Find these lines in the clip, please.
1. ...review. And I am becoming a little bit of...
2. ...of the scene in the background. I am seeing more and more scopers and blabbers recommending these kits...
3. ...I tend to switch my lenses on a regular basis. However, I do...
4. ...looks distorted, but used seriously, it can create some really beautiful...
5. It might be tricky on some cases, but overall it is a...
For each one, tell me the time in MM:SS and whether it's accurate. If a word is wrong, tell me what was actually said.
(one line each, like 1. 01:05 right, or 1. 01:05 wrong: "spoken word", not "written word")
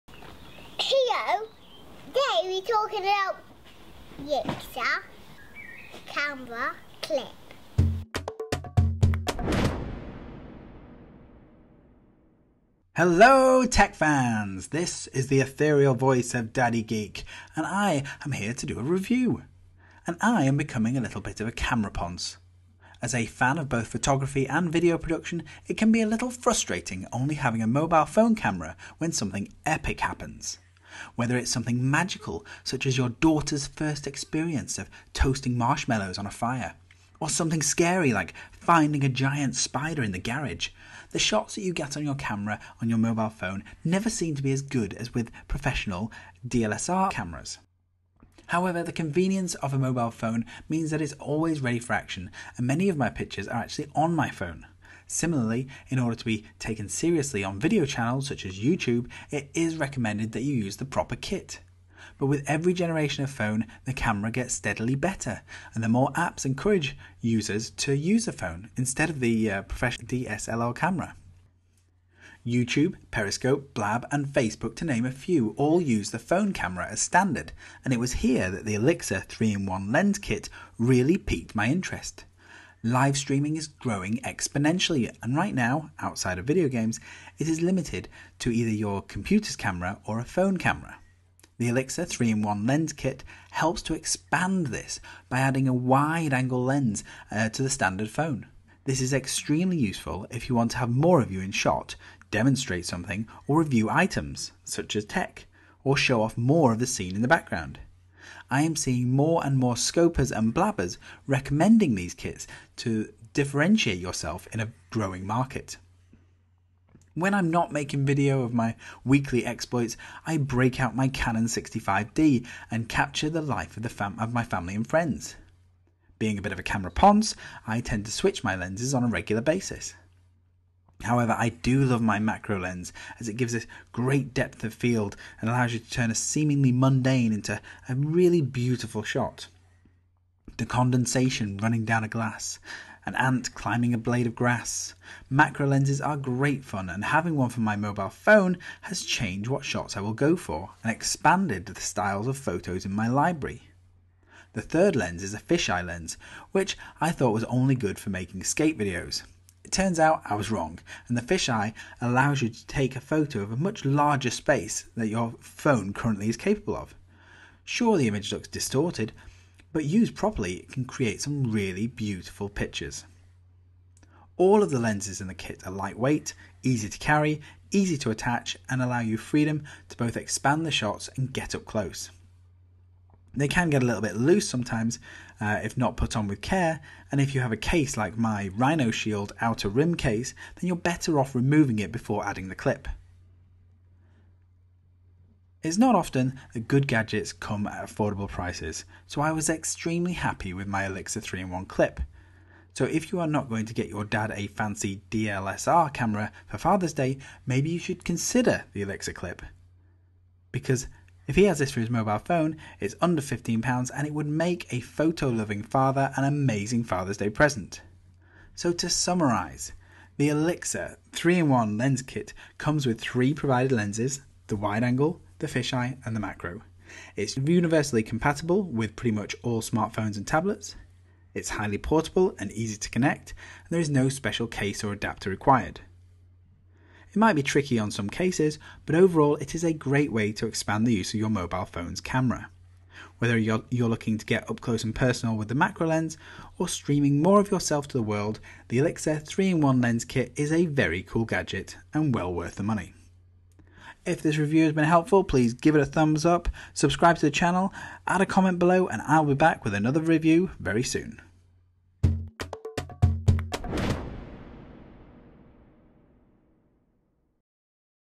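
1. 00:18 right
2. 01:46 right
3. 02:07 right
4. 02:48 wrong: "properly", not "seriously"
5. 03:57 right.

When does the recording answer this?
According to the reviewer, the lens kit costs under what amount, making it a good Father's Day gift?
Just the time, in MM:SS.
03:33.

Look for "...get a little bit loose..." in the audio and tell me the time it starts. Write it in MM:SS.
03:03.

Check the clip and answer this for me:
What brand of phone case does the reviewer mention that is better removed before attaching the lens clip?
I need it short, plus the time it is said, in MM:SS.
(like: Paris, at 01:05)
Rhino Shield, at 03:08.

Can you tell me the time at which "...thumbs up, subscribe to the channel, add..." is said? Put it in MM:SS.
04:15.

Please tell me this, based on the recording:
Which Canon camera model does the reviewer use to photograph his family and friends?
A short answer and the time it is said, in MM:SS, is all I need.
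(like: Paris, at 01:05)
Canon 65D, at 02:01.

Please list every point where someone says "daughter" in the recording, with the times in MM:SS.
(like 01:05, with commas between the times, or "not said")
00:33.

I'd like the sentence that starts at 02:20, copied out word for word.
The condensation running down a glass, an ant climbing a blade of grass.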